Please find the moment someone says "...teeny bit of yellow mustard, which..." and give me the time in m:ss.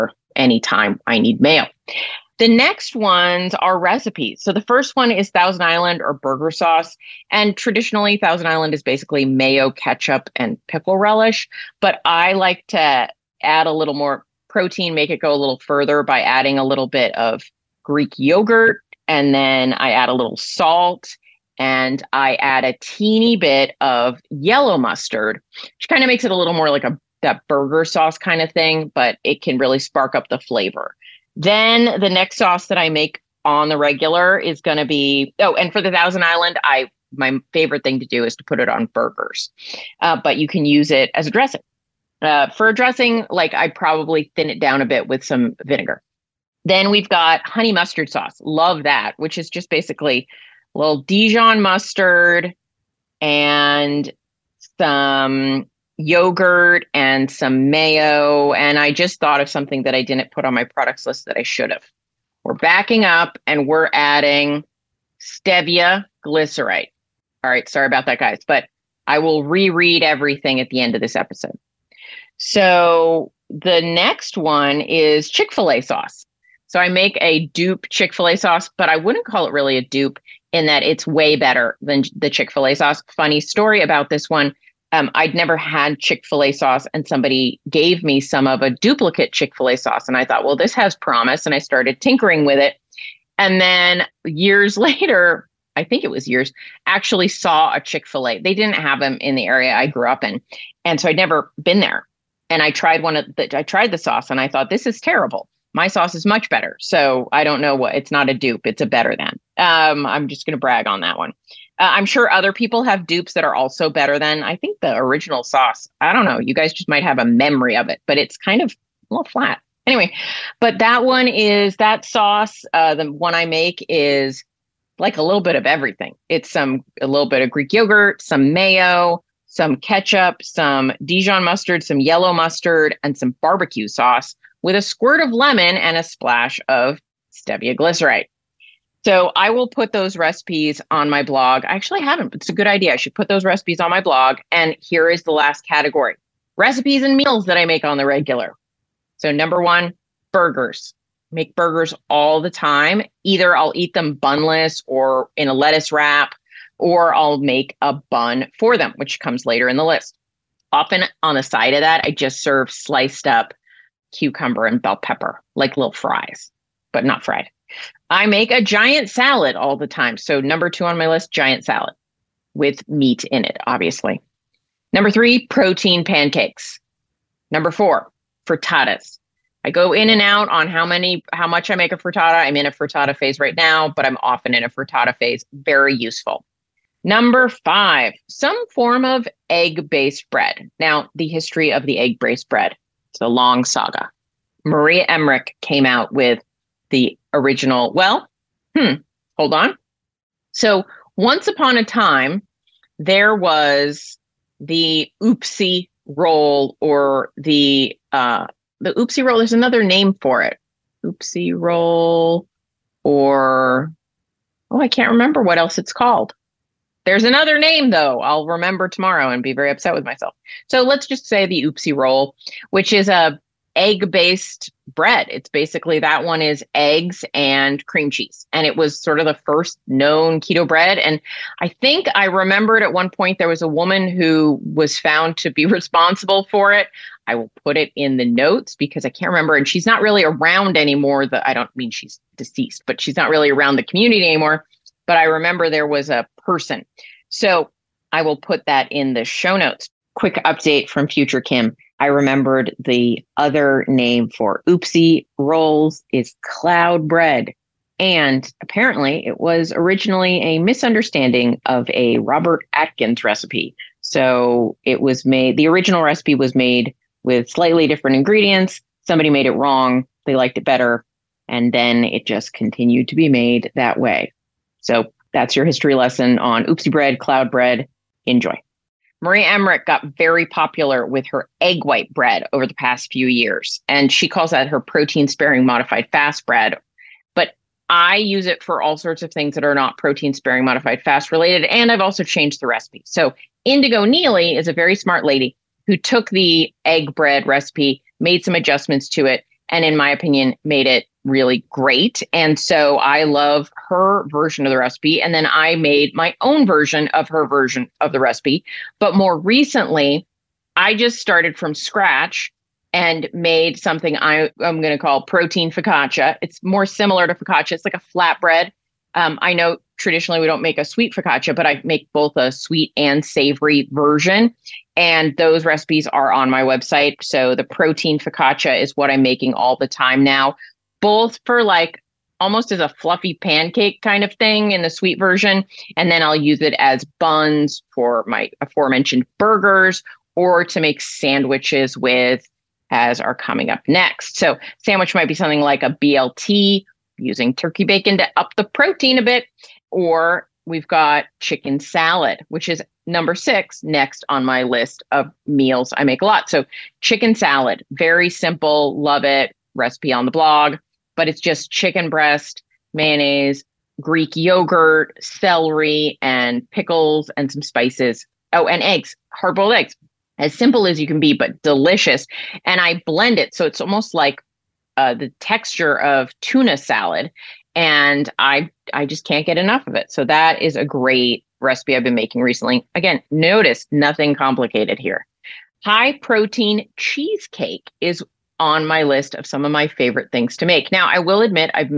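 0:22.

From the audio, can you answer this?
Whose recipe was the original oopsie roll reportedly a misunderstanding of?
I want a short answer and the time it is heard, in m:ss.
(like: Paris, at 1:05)
Robert Atkins, at 4:22.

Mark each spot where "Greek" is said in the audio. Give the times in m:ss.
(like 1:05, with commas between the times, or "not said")
0:17, 2:07, 6:03.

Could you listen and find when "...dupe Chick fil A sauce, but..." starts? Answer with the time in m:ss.
1:17.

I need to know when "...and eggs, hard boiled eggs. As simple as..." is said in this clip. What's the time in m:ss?
6:08.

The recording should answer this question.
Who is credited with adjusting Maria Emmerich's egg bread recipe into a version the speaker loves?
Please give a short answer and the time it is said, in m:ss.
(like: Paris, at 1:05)
Indigo Neely, at 4:53.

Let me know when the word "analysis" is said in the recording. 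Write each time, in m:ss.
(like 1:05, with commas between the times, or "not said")
not said.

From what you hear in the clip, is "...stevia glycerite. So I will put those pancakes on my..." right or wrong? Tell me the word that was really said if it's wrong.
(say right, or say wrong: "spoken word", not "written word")
wrong: "recipes", not "pancakes".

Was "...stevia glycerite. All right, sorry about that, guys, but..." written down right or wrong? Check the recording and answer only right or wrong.
right.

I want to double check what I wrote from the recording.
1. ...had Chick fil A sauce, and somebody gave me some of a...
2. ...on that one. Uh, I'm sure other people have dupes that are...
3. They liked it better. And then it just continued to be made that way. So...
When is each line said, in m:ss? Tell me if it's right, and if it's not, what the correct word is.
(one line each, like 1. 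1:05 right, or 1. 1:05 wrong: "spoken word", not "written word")
1. 1:25 right
2. 1:50 right
3. 4:30 right.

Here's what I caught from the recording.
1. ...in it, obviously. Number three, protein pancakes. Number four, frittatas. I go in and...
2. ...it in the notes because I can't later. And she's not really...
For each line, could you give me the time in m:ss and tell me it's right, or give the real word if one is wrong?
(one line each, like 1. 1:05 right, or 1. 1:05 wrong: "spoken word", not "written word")
1. 2:53 right
2. 3:57 wrong: "remember", not "later".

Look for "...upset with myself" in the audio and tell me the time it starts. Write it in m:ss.
3:39.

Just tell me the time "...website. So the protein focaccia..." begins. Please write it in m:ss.
5:26.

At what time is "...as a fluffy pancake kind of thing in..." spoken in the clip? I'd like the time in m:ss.
5:32.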